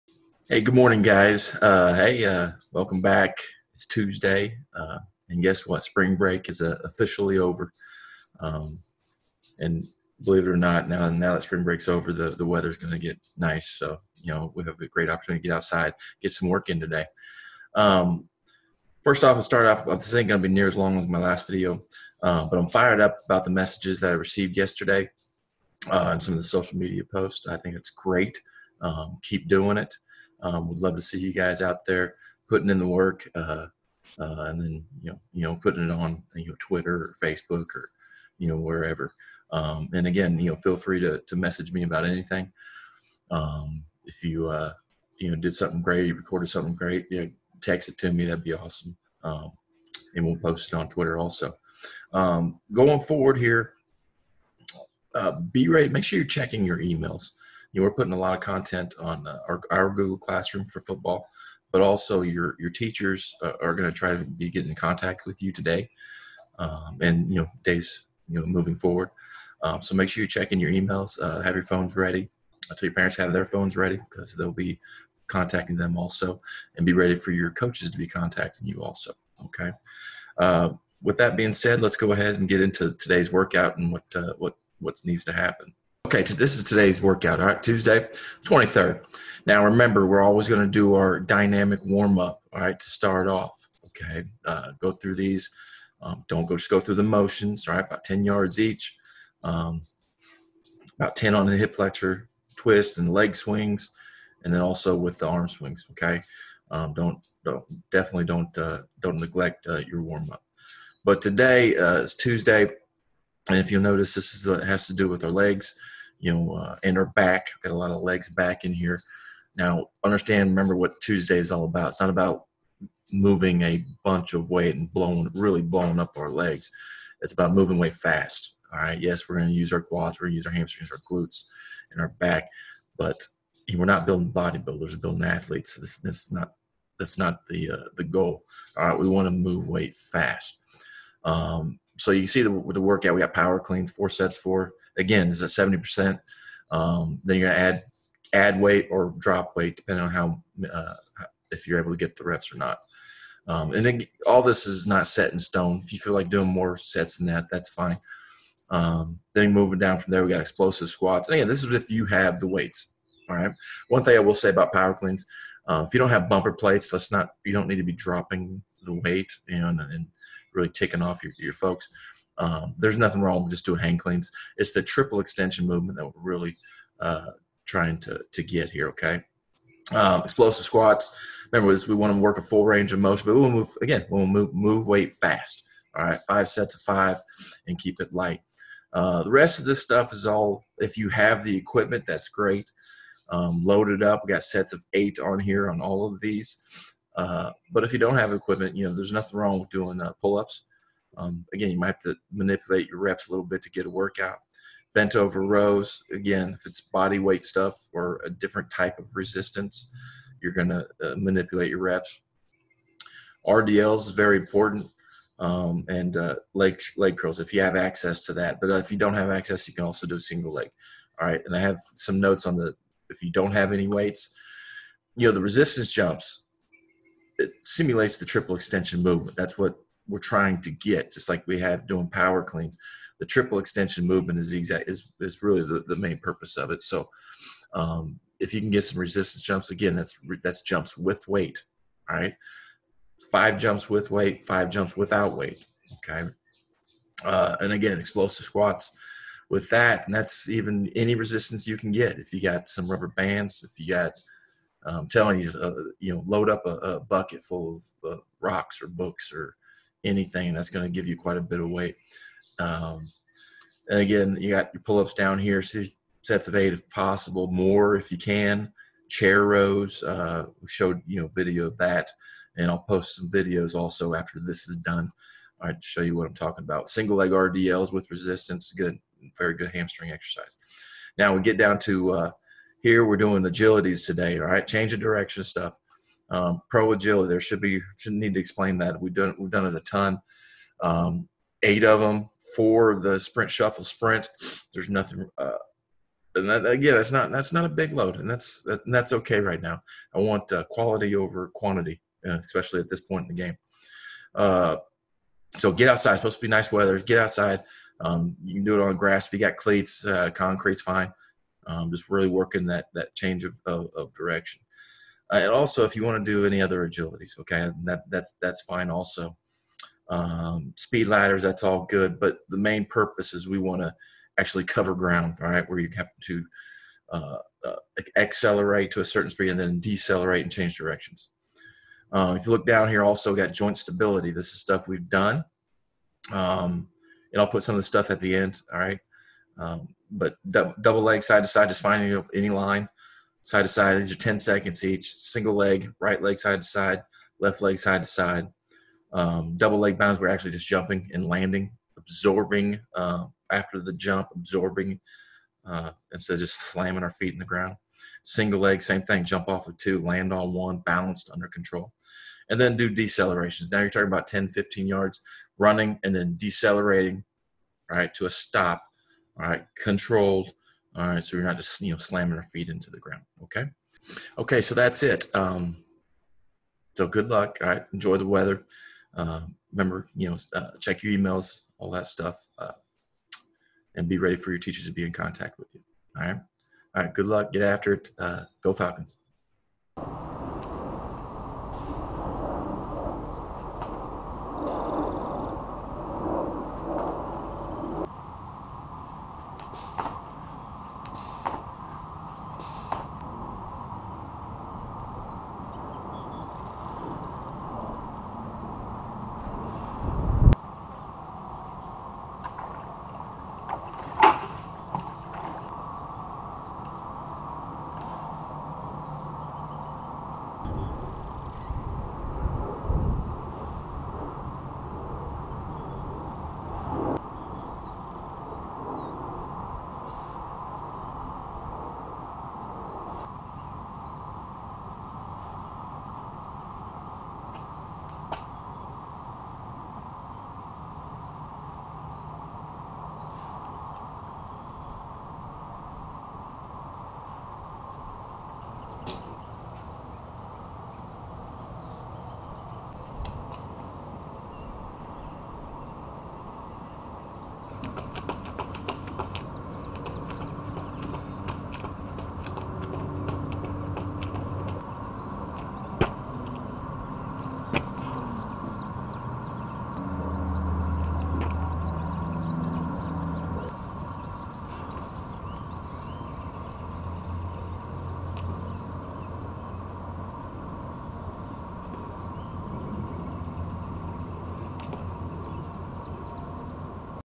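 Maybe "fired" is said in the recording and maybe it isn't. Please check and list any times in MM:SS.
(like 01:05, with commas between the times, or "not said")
00:22.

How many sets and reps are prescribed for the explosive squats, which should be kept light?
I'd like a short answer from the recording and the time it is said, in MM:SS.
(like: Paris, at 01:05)
5 sets of 5, at 03:06.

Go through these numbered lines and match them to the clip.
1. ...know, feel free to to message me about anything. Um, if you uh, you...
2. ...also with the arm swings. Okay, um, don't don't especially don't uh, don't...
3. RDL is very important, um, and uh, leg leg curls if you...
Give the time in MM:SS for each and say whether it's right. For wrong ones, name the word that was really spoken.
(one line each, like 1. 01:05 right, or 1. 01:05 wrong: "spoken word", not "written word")
1. 00:40 right
2. 01:44 wrong: "definitely", not "especially"
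3. 03:33 right.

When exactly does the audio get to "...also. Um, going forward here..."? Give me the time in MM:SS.
00:51.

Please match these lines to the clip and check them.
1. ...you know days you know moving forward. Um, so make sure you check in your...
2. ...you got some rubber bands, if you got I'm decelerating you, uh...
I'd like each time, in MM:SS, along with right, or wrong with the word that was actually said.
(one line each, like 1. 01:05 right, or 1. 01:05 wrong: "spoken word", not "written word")
1. 01:07 right
2. 04:12 wrong: "telling", not "decelerating".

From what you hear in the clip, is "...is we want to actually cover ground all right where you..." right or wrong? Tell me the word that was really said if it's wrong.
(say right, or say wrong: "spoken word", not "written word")
right.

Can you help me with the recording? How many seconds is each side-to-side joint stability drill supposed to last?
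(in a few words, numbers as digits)
10 seconds.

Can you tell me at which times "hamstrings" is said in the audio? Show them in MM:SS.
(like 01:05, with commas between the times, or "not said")
02:10, 04:39.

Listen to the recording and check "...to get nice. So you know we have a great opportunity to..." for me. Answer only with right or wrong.
right.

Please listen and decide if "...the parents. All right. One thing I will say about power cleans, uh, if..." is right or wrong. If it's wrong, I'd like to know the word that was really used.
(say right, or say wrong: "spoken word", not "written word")
wrong: "weights", not "parents".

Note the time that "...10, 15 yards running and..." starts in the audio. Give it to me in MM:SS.
06:04.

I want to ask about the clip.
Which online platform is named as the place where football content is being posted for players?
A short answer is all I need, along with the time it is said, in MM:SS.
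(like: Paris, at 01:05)
Google Classroom, at 00:59.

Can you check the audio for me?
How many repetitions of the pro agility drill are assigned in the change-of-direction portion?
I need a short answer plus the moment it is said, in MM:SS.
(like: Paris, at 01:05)
8, at 04:51.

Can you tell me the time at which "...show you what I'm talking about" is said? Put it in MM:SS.
04:35.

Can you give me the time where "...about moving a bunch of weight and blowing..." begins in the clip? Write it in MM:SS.
02:02.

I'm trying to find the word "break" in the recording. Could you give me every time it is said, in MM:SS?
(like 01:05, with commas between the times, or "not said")
00:06, 00:11.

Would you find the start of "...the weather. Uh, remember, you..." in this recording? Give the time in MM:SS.
06:18.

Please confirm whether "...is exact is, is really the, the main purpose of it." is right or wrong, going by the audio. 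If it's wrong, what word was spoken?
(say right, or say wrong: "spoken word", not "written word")
right.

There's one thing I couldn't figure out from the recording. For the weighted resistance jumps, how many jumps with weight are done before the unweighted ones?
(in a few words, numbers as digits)
5.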